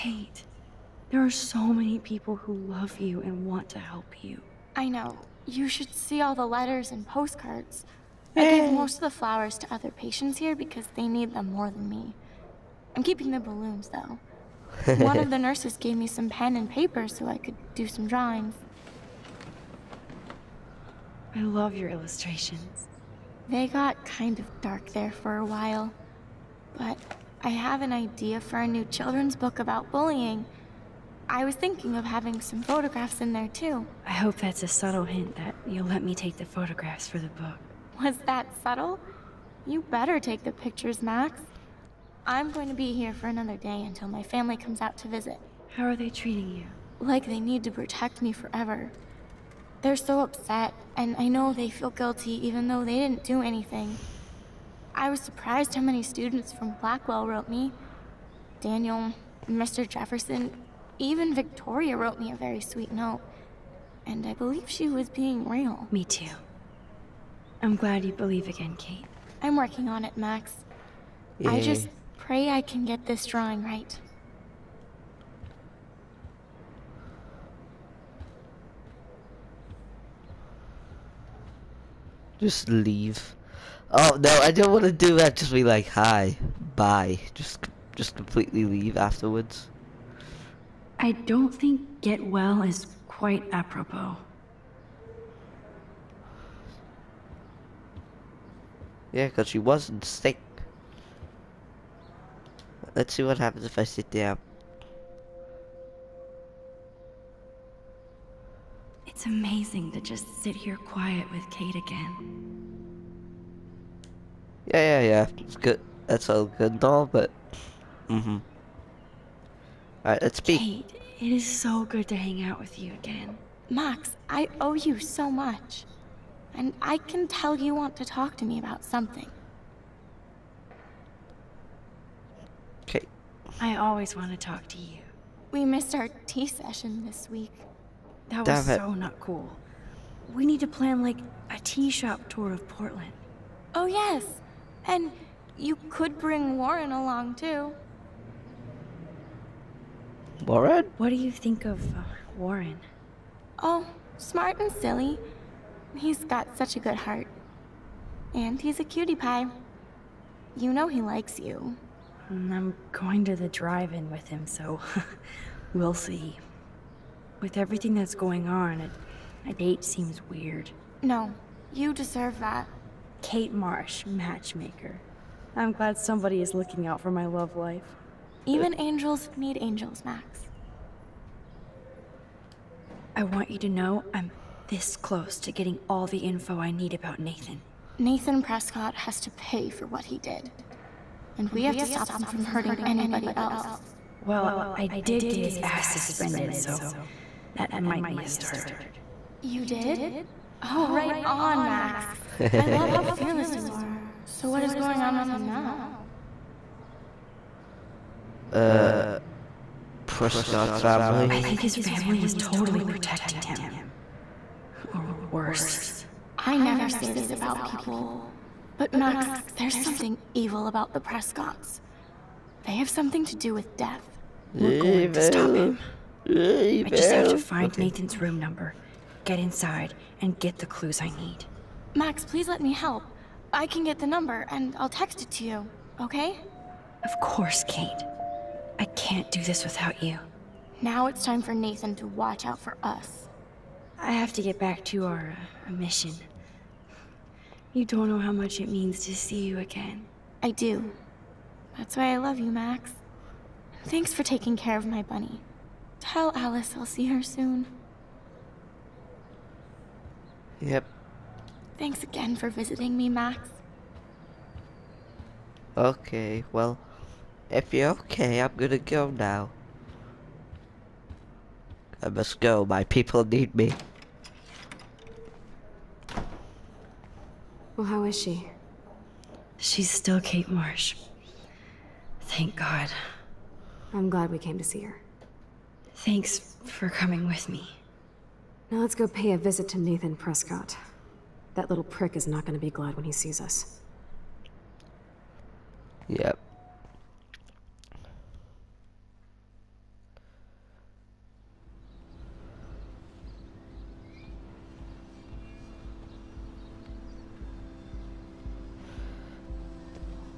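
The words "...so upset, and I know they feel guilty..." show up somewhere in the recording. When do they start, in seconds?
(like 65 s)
49 s.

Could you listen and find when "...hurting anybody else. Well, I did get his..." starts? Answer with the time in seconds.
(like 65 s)
192 s.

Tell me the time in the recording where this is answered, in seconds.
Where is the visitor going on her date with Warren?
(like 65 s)
163 s.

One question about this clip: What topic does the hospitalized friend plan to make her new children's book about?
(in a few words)
bullying.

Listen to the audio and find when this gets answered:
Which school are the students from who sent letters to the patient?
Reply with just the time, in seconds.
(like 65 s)
56 s.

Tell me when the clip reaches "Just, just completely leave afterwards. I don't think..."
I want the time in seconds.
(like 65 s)
87 s.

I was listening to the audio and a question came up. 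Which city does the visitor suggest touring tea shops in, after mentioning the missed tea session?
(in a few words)
Portland.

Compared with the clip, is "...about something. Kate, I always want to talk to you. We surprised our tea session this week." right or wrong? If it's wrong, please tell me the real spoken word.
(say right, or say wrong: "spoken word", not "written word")
wrong: "missed", not "surprised".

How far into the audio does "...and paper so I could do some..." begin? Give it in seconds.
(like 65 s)
16 s.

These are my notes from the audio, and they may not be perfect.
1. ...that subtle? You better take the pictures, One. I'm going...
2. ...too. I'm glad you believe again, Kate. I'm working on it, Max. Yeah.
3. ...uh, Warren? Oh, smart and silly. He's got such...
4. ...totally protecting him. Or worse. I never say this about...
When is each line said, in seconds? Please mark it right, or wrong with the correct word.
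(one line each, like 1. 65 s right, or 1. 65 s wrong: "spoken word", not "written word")
1. 38 s wrong: "Max", not "One"
2. 66 s right
3. 151 s right
4. 212 s right.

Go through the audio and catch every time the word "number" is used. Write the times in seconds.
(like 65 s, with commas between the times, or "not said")
228 s, 234 s.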